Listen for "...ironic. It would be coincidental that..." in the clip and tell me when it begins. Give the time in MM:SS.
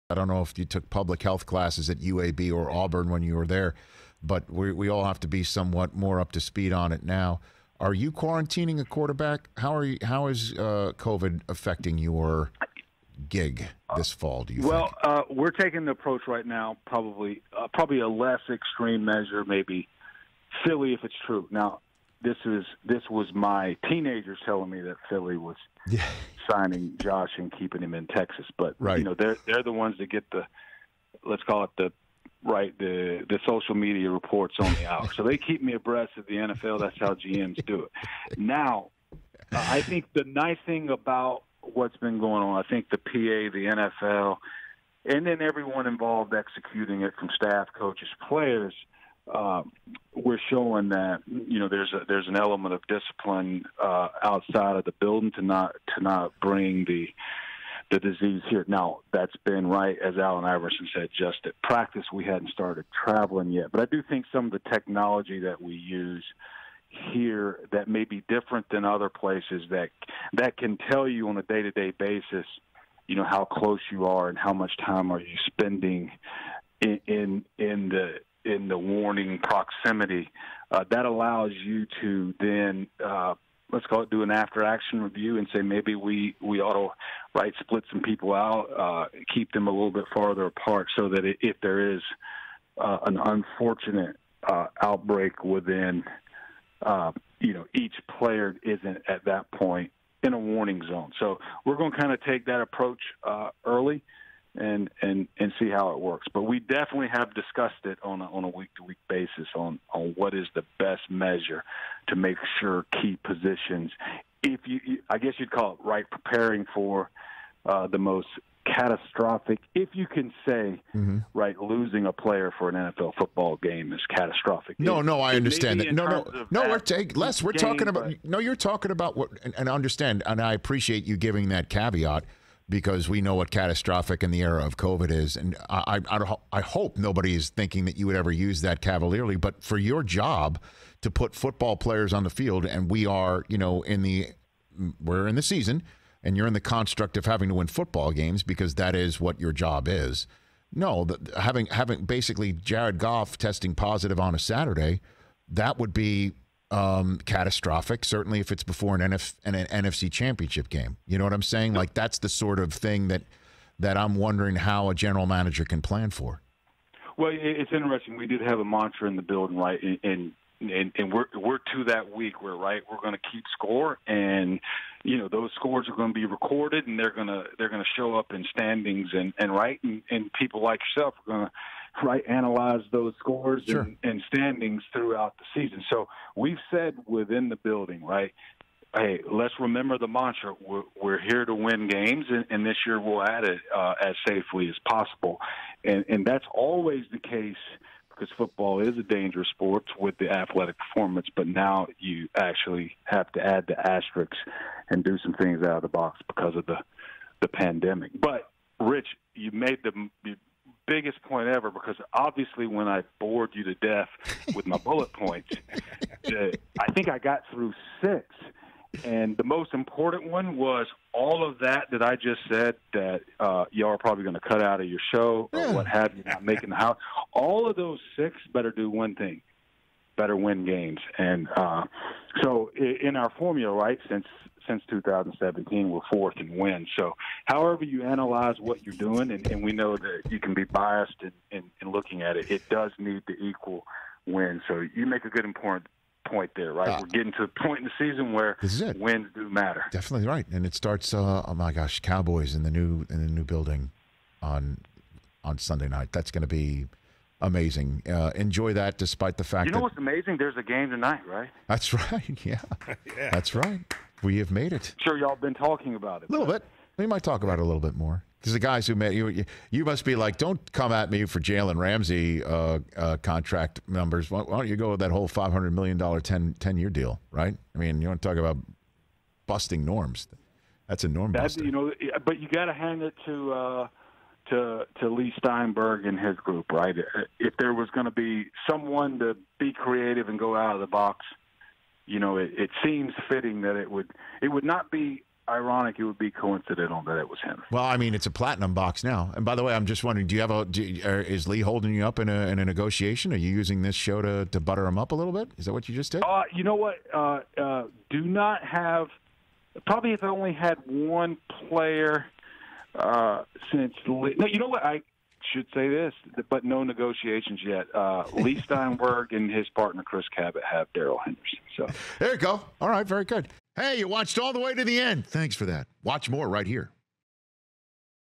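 04:55.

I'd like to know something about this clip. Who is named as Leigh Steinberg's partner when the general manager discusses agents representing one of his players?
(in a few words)
Chris Cabott.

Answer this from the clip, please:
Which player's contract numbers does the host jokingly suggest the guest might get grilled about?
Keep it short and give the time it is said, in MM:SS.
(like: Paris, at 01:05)
Jalen Ramsey, at 04:31.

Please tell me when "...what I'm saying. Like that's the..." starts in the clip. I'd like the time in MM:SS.
02:41.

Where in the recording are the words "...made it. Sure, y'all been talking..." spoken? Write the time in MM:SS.
04:24.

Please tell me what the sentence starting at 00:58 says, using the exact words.
Now that's been right, as Allen Iverson said, just at practice we hadn't started traveling yet.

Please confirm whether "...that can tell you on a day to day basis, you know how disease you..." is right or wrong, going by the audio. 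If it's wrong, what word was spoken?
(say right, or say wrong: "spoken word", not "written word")
wrong: "close", not "disease".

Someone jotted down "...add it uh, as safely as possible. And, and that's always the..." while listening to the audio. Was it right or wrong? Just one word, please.
right.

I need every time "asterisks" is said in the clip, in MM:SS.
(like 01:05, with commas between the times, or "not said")
03:23.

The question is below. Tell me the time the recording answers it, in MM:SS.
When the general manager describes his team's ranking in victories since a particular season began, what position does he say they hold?
03:56.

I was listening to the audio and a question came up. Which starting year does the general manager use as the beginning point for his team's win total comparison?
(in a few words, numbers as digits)
2017.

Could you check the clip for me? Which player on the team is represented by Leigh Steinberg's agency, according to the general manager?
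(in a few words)
Darrell Henderson.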